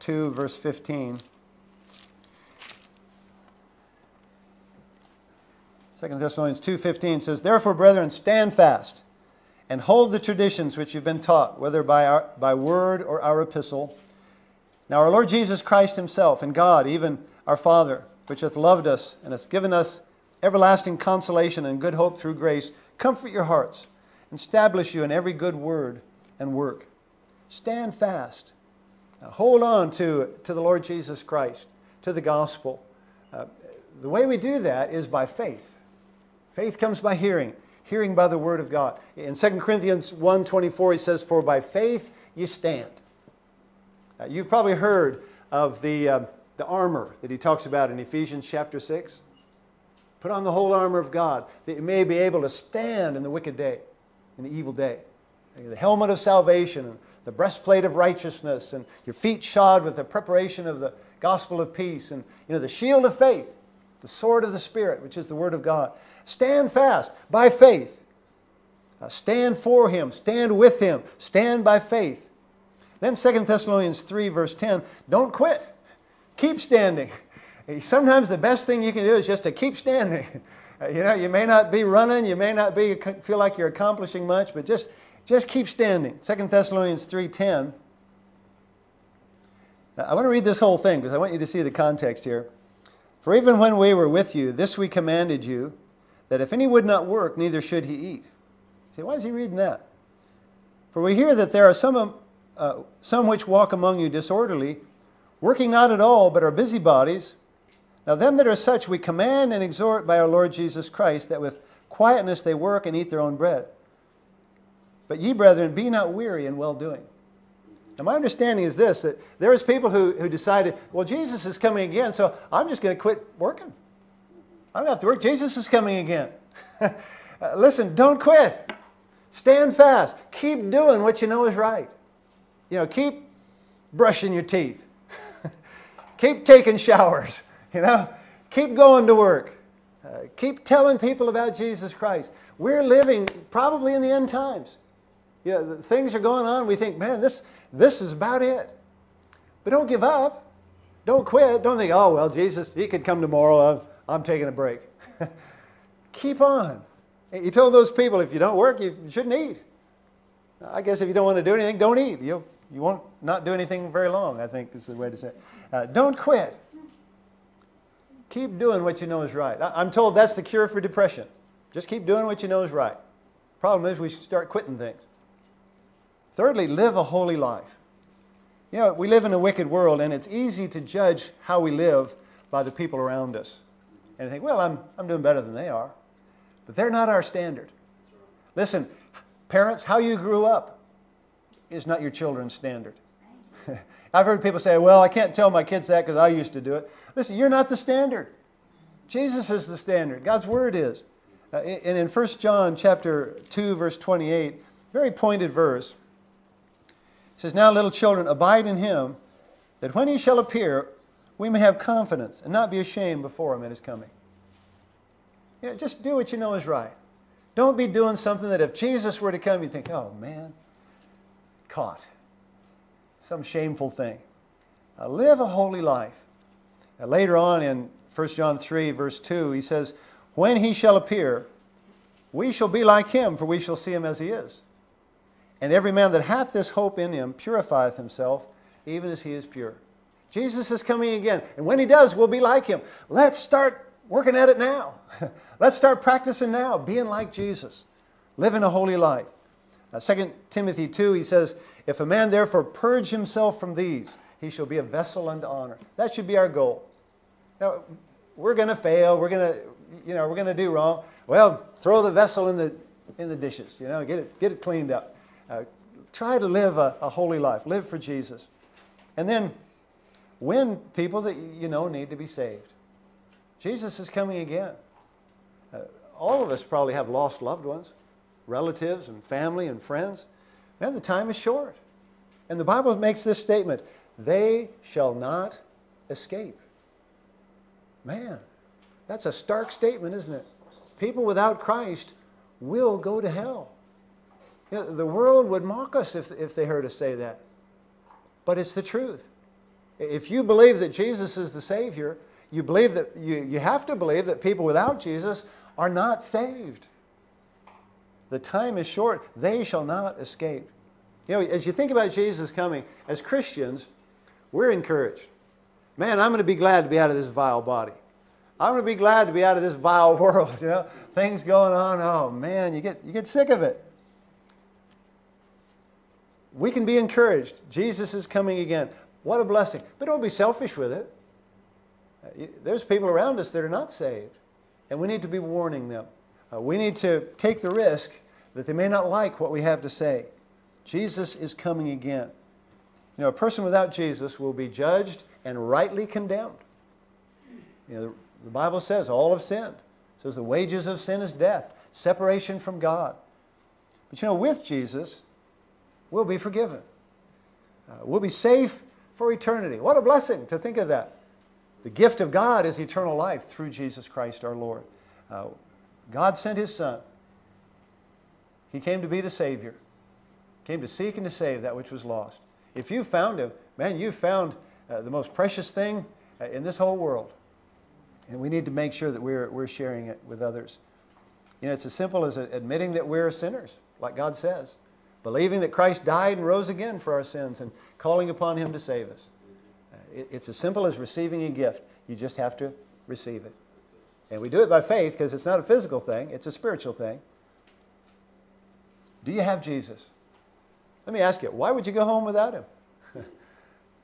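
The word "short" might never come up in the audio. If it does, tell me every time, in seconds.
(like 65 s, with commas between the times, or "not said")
281 s, 308 s.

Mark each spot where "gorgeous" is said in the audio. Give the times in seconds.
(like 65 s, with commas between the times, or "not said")
not said.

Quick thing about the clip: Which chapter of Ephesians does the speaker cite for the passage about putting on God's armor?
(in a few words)
Chapter 6.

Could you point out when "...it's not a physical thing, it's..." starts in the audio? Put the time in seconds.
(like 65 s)
395 s.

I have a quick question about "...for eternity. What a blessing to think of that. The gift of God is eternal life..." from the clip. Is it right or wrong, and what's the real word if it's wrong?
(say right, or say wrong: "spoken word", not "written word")
right.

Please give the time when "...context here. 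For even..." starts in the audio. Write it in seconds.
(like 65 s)
91 s.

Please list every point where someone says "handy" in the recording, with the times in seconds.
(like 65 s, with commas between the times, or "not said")
not said.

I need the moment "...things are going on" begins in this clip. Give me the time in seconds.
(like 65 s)
145 s.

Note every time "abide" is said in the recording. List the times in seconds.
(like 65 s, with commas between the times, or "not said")
208 s.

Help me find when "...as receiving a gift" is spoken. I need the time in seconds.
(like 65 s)
390 s.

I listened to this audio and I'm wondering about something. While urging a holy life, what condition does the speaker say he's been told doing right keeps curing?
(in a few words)
Depression.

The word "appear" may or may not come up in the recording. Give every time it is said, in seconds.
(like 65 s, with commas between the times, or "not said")
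210 s, 230 s.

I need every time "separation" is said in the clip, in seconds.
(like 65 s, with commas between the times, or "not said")
351 s.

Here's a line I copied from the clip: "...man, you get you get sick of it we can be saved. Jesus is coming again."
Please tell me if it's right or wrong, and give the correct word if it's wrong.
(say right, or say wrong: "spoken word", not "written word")
wrong: "encouraged", not "saved".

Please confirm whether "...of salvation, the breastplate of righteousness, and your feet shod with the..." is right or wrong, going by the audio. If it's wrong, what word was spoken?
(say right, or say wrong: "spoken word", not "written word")
right.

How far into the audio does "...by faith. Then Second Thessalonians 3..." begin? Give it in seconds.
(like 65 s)
71 s.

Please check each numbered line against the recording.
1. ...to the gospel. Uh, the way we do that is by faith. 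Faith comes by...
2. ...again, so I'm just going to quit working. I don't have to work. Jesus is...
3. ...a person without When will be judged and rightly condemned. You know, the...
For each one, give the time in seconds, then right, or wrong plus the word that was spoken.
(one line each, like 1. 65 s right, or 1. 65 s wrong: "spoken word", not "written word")
1. 32 s right
2. 121 s right
3. 343 s wrong: "Jesus", not "When".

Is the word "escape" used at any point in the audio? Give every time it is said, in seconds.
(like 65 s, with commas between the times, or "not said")
286 s, 310 s.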